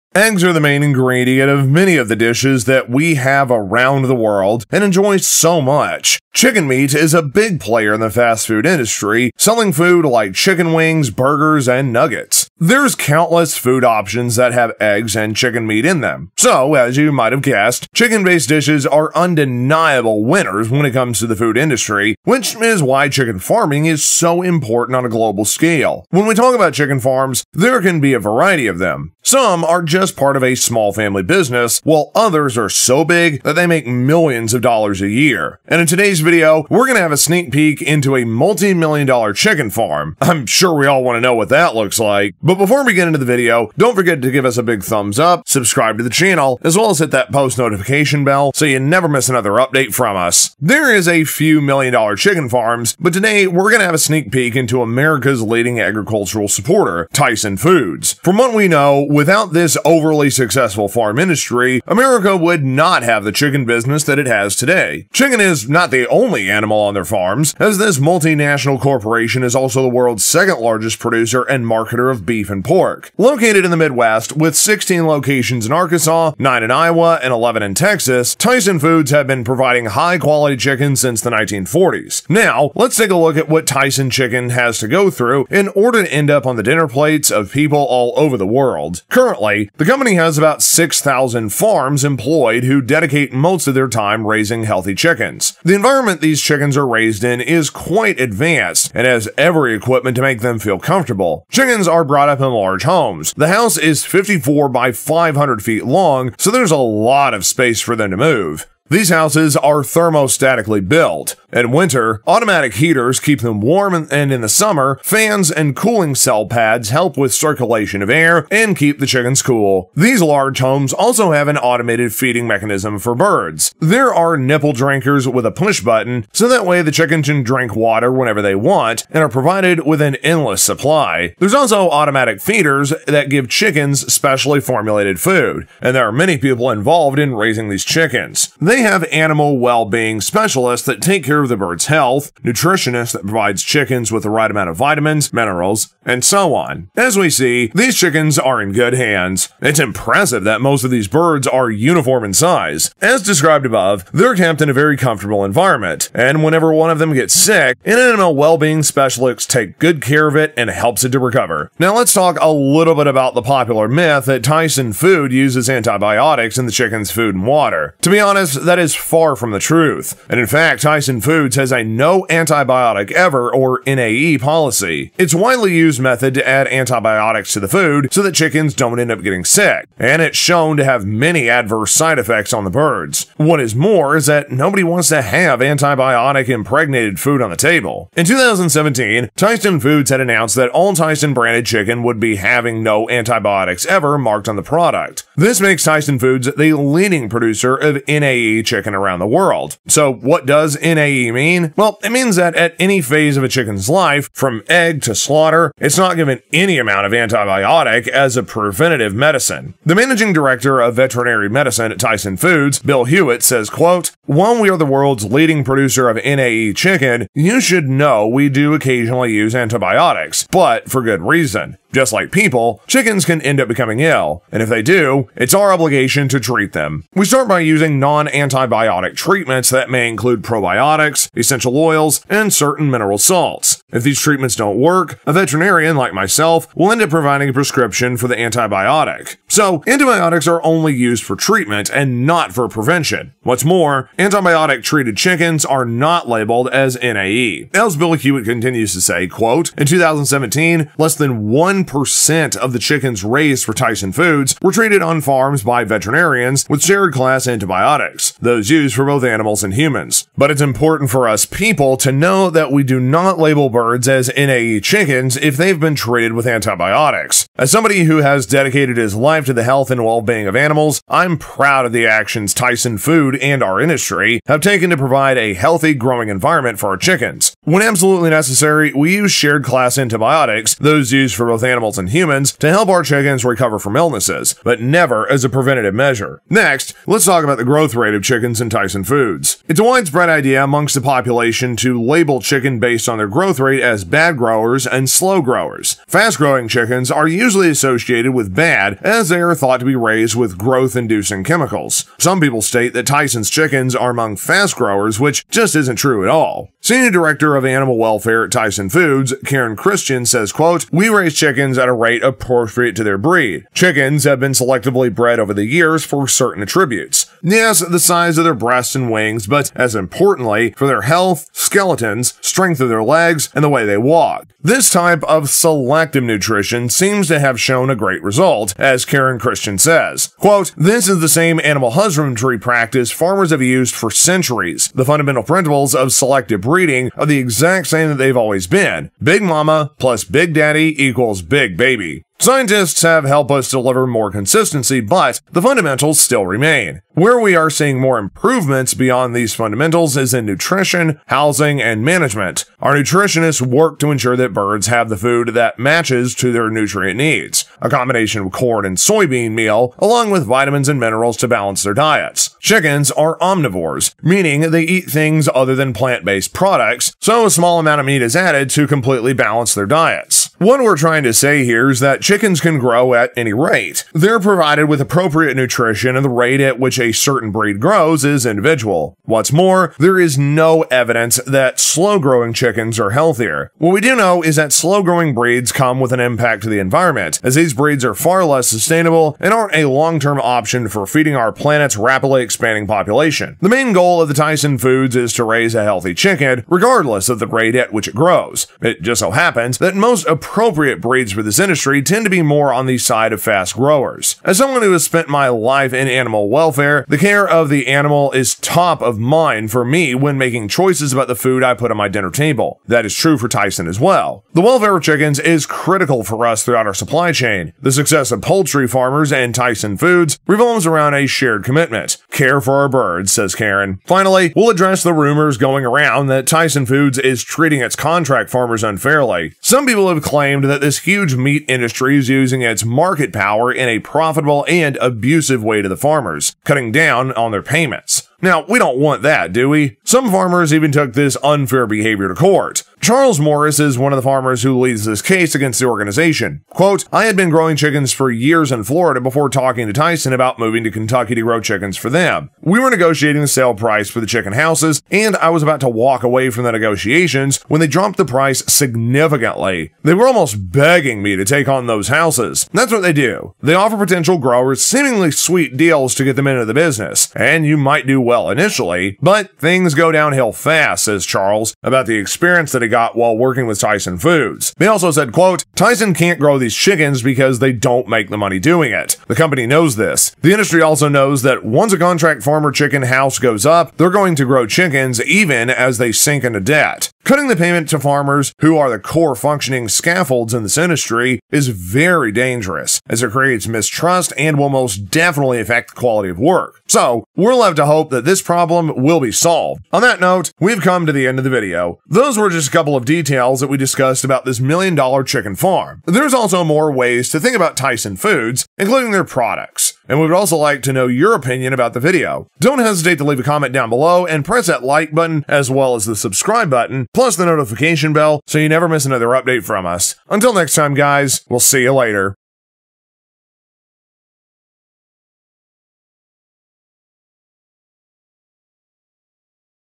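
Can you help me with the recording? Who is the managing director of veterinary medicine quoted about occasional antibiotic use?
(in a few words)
Bill Hewitt.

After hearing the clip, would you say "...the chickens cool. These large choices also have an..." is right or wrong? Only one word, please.
wrong.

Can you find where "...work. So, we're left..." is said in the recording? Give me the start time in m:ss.
8:16.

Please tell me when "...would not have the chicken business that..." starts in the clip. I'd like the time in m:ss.
1:02.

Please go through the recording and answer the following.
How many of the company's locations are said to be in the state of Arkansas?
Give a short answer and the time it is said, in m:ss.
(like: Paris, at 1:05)
16, at 1:14.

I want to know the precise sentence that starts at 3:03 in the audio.
What is more is that nobody wants to have antibiotic impregnated food on the table.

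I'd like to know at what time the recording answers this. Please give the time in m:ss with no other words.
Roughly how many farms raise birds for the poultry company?
1:30.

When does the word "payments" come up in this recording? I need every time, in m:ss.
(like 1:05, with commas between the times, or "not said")
7:17, 8:07.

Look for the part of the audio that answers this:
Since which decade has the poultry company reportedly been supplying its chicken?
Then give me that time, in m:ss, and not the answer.
1:21.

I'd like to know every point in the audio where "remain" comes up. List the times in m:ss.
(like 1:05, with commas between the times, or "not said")
5:46.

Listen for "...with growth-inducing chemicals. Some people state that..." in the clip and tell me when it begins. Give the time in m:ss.
5:00.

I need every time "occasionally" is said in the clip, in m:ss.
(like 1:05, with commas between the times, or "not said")
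3:38.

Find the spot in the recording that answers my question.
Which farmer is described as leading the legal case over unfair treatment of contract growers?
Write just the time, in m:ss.
7:22.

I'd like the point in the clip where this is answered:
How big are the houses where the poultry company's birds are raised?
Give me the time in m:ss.
1:44.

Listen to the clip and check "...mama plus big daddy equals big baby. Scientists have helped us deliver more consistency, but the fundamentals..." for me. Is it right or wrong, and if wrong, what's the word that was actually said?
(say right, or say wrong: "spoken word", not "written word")
right.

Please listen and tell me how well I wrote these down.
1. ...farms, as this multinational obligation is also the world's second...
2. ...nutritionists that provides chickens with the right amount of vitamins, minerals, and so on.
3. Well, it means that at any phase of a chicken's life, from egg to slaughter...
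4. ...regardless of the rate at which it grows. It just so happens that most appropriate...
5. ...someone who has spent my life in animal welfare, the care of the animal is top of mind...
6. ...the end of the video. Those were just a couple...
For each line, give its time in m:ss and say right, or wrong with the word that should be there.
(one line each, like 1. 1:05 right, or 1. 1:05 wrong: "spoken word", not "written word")
1. 1:07 wrong: "corporation", not "obligation"
2. 2:22 right
3. 3:21 right
4. 6:36 right
5. 6:44 right
6. 8:21 right.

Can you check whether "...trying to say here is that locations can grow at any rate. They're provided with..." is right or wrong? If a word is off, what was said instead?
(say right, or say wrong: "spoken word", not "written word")
wrong: "chickens", not "locations".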